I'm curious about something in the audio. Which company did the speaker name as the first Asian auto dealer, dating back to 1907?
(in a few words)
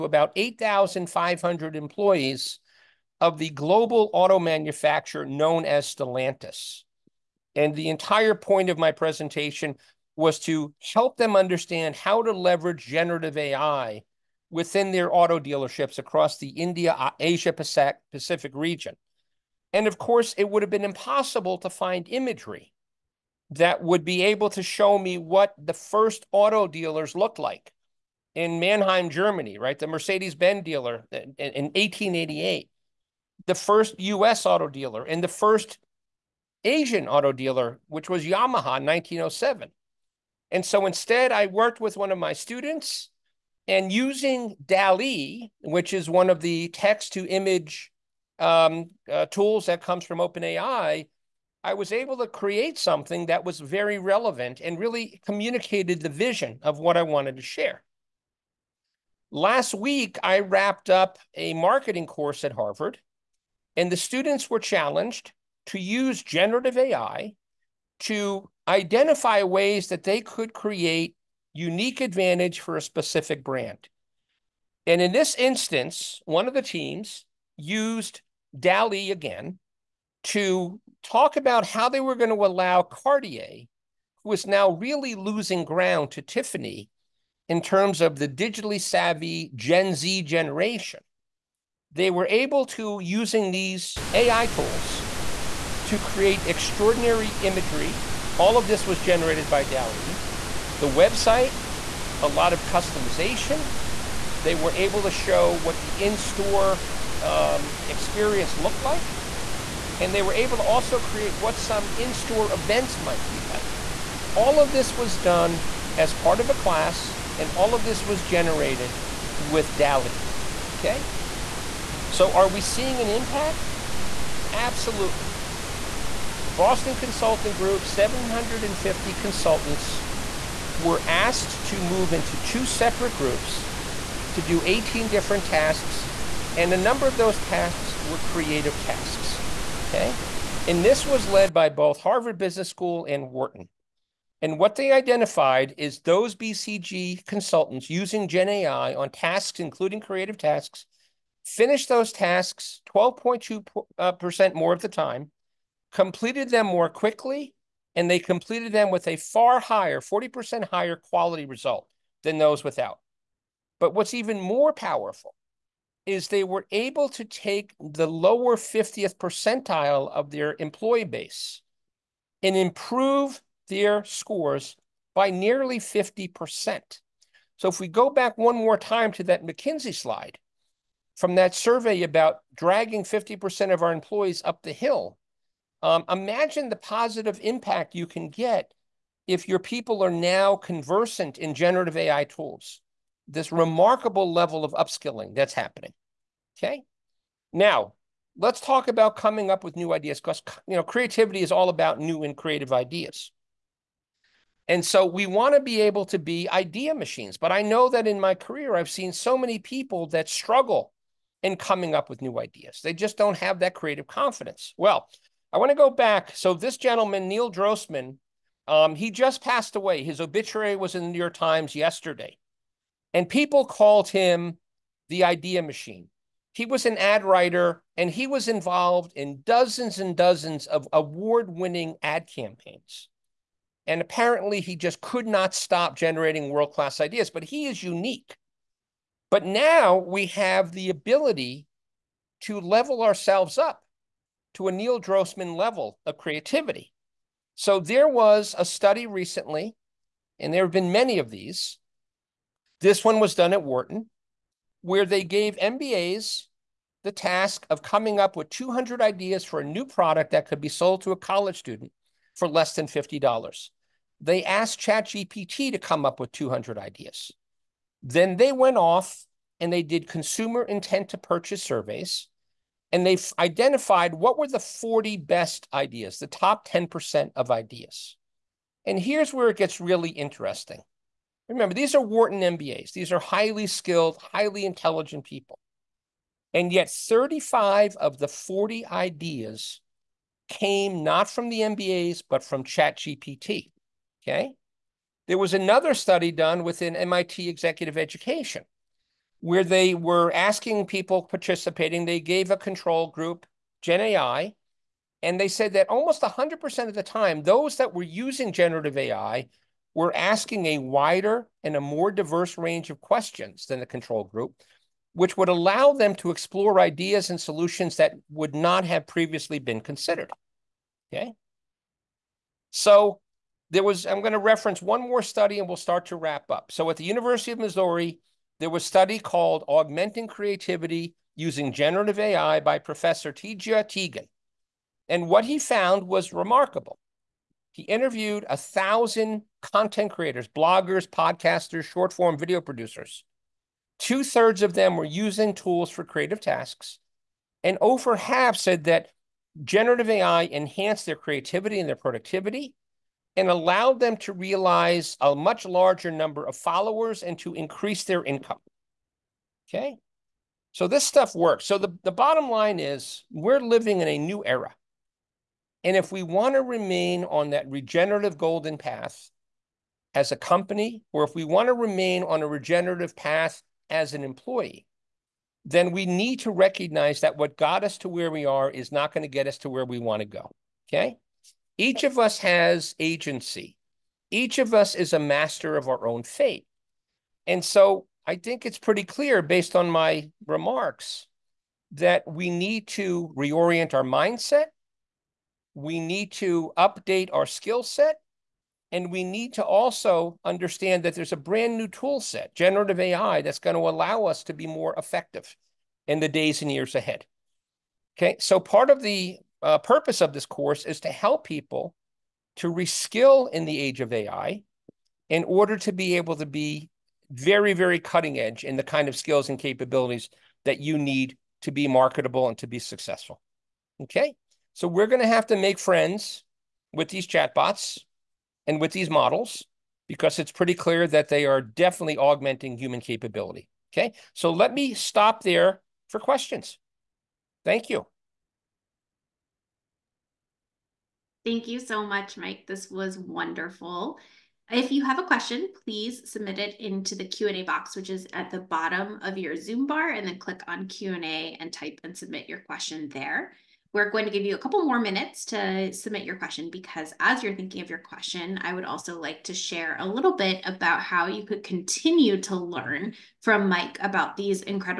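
Yamaha.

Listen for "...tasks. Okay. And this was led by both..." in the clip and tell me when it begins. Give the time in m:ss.
2:18.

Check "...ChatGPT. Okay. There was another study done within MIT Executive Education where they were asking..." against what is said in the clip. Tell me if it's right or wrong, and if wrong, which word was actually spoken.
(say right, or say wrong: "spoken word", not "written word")
right.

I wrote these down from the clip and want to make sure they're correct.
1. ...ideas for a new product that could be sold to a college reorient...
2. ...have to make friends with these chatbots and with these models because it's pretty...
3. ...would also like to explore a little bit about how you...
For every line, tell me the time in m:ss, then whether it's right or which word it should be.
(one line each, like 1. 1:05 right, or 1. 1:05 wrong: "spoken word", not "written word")
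1. 4:19 wrong: "student", not "reorient"
2. 7:05 right
3. 7:38 wrong: "share", not "explore".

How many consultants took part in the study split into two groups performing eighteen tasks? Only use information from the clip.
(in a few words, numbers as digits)
750.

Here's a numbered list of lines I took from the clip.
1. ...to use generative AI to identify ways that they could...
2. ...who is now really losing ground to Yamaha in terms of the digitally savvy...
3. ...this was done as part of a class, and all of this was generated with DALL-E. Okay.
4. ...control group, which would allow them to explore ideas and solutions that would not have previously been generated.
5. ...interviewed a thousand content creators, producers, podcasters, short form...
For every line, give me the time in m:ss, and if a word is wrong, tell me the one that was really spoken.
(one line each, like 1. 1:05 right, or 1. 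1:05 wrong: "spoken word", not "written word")
1. 1:05 right
2. 1:24 wrong: "Tiffany", not "Yamaha"
3. 1:54 right
4. 5:13 wrong: "considered", not "generated"
5. 5:37 wrong: "bloggers", not "producers".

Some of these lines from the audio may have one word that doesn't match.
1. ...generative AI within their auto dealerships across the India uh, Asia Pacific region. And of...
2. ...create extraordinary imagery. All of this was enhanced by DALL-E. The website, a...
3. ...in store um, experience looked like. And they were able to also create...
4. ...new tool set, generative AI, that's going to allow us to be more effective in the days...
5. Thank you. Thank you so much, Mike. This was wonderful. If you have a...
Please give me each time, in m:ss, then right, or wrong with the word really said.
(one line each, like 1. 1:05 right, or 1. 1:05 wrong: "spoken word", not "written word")
1. 0:12 right
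2. 1:35 wrong: "generated", not "enhanced"
3. 1:45 right
4. 6:41 right
5. 7:17 right.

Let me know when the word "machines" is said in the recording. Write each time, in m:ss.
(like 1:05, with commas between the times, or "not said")
3:26, 3:45.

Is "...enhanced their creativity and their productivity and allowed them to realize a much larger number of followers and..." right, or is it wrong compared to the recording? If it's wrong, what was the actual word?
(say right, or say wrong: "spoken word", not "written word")
right.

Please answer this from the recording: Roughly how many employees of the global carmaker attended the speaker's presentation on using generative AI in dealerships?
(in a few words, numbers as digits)
8,500.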